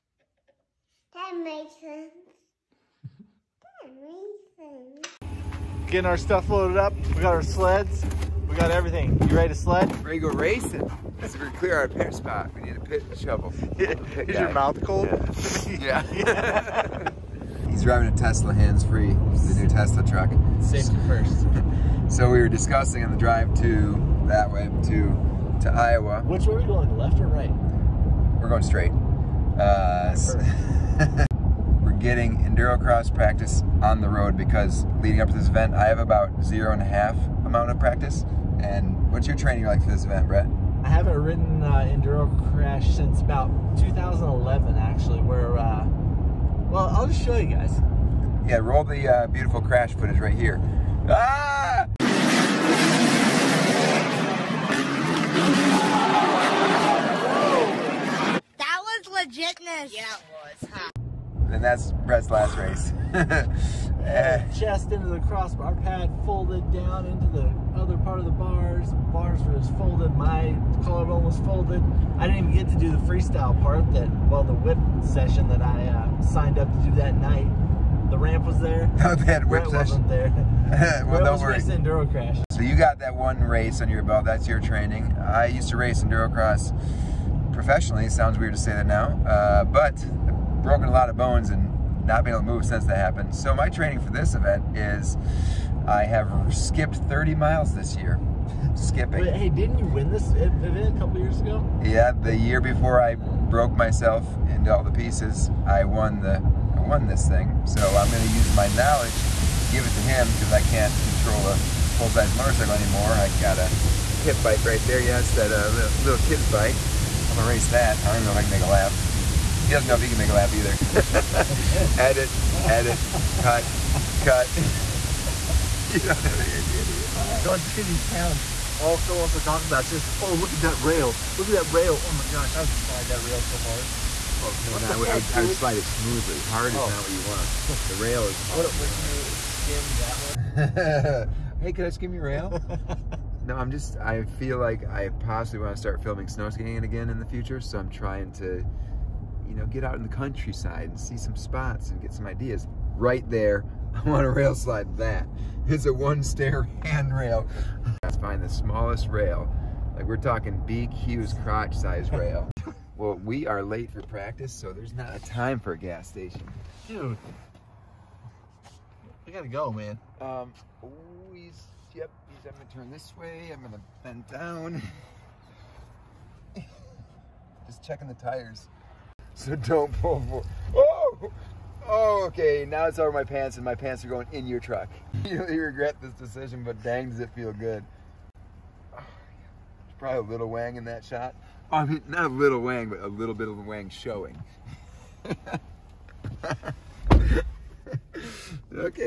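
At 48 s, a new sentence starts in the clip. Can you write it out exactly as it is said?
Yeah, roll the uh, beautiful crash footage right here.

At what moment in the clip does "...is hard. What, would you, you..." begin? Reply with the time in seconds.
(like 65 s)
138 s.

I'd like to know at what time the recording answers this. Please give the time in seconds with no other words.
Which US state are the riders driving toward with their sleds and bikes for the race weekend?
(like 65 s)
25 s.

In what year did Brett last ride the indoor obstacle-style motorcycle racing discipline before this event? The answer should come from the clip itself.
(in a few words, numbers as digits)
2011.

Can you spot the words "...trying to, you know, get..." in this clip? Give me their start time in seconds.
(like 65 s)
147 s.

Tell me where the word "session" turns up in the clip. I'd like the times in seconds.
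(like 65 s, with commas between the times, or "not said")
75 s, 79 s.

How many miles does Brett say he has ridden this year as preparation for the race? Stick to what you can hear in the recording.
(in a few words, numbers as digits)
30.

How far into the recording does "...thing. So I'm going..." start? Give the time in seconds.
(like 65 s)
107 s.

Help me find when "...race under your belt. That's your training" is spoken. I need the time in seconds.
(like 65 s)
83 s.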